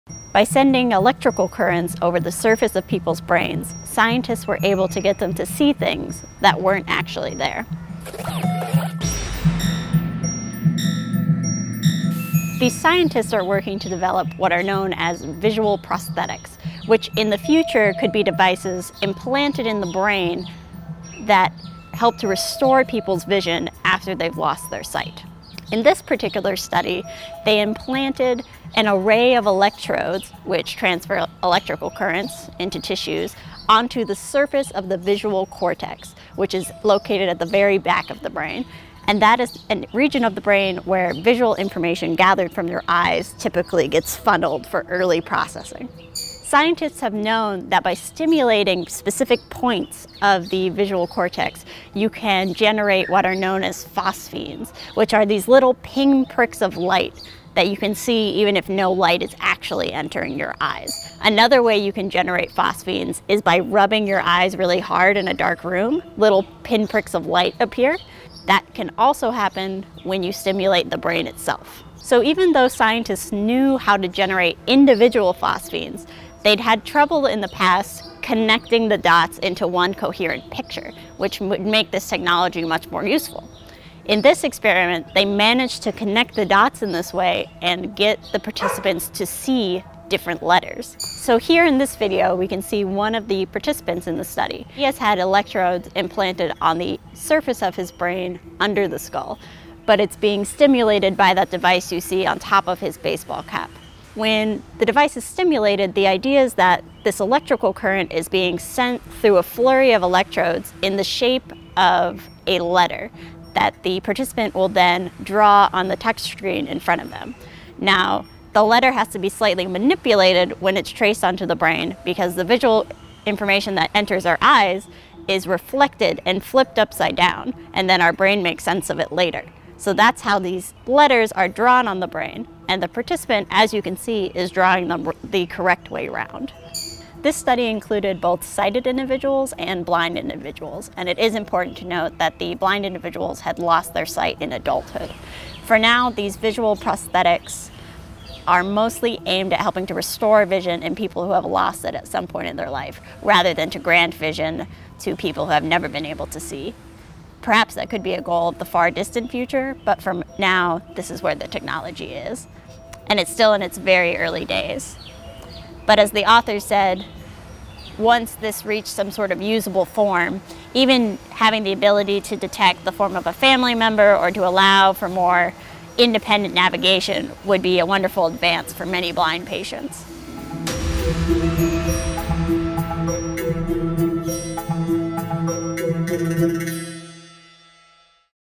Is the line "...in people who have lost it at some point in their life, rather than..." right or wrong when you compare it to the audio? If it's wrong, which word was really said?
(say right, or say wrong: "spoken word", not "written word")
right.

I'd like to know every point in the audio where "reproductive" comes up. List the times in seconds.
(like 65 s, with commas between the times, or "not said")
not said.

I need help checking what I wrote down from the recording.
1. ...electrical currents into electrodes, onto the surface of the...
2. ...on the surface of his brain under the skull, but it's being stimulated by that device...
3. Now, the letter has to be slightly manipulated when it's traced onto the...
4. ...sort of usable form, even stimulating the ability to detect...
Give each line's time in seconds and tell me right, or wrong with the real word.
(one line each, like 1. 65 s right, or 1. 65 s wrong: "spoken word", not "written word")
1. 31 s wrong: "tissues", not "electrodes"
2. 96 s right
3. 117 s right
4. 169 s wrong: "having", not "stimulating".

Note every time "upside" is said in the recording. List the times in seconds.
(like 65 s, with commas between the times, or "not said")
126 s.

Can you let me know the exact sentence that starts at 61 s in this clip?
Another way you can generate phosphenes is by rubbing your eyes really hard in a dark room.